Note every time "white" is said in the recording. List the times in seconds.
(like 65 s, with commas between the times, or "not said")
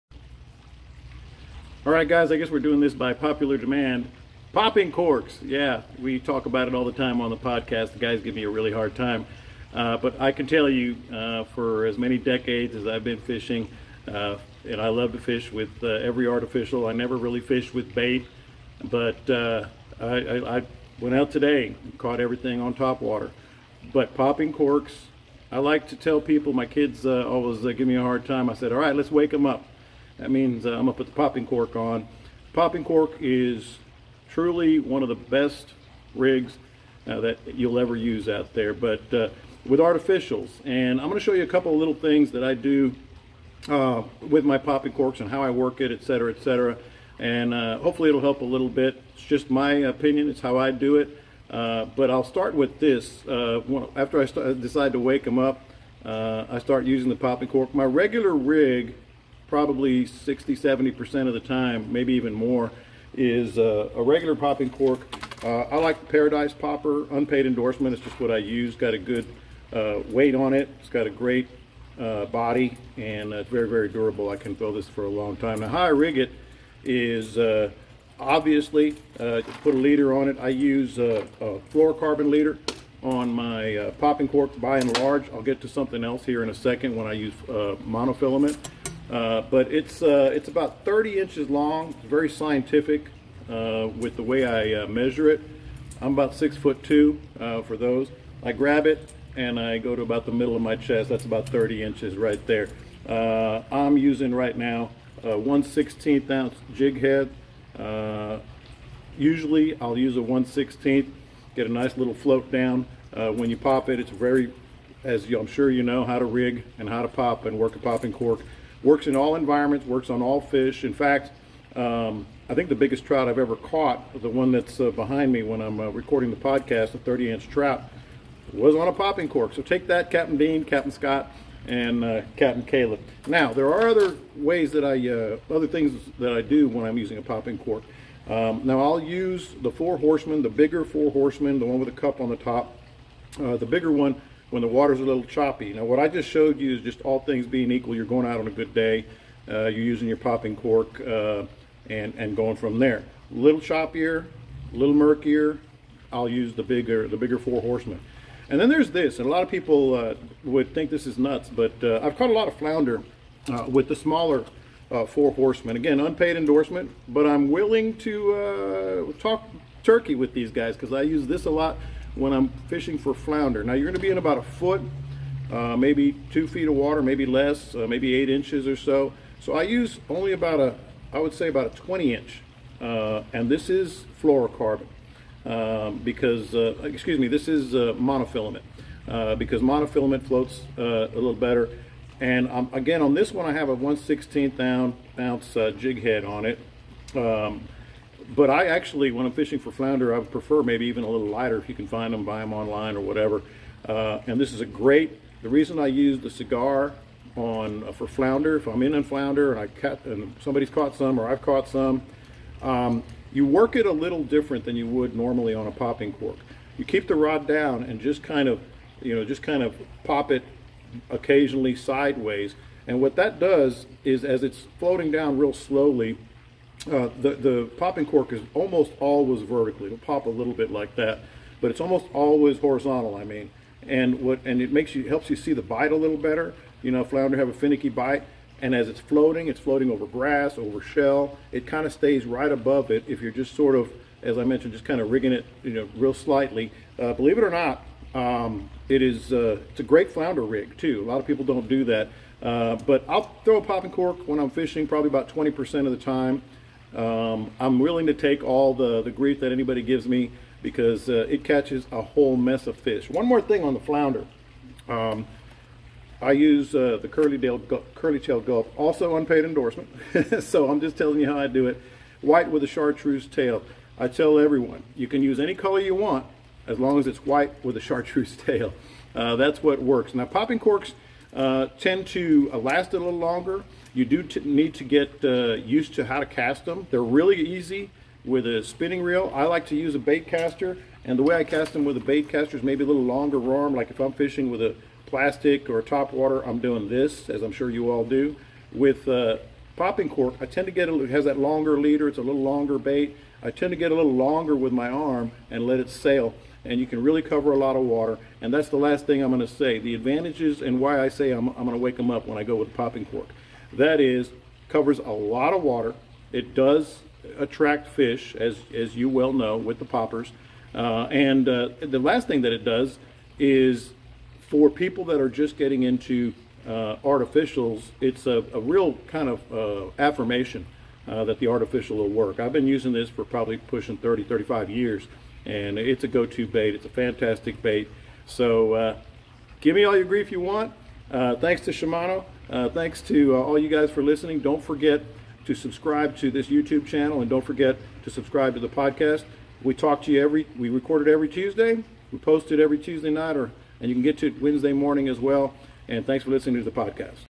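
272 s, 277 s.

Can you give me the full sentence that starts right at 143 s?
Uh, the bigger one when the water's a little choppy.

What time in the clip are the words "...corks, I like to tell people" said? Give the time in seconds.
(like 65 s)
24 s.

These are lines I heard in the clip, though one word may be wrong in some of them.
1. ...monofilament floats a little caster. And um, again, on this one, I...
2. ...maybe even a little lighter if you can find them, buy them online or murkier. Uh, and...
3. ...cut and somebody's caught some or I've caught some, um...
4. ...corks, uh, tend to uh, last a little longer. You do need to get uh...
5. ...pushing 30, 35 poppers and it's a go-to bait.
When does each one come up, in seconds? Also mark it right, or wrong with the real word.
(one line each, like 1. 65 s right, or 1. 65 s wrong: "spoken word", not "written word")
1. 189 s wrong: "better", not "caster"
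2. 200 s wrong: "whatever", not "murkier"
3. 209 s right
4. 280 s right
5. 333 s wrong: "years", not "poppers".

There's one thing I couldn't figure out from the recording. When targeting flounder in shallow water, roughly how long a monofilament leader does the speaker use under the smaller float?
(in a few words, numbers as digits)
20 inches.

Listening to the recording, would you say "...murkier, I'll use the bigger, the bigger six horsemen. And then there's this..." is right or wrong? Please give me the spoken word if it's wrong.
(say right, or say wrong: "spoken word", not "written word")
wrong: "four", not "six".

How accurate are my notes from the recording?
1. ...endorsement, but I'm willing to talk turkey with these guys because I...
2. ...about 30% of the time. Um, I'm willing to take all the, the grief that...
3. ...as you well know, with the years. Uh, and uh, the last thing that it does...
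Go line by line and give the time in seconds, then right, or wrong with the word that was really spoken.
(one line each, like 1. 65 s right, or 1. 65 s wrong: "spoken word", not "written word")
1. 166 s right
2. 255 s wrong: "20", not "30"
3. 318 s wrong: "poppers", not "years".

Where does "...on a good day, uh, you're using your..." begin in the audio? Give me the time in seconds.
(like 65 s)
148 s.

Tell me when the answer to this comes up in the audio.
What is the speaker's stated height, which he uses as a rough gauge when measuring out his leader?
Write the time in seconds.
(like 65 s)
96 s.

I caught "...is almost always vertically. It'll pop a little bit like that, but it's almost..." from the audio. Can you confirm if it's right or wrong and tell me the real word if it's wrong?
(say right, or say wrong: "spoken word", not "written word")
right.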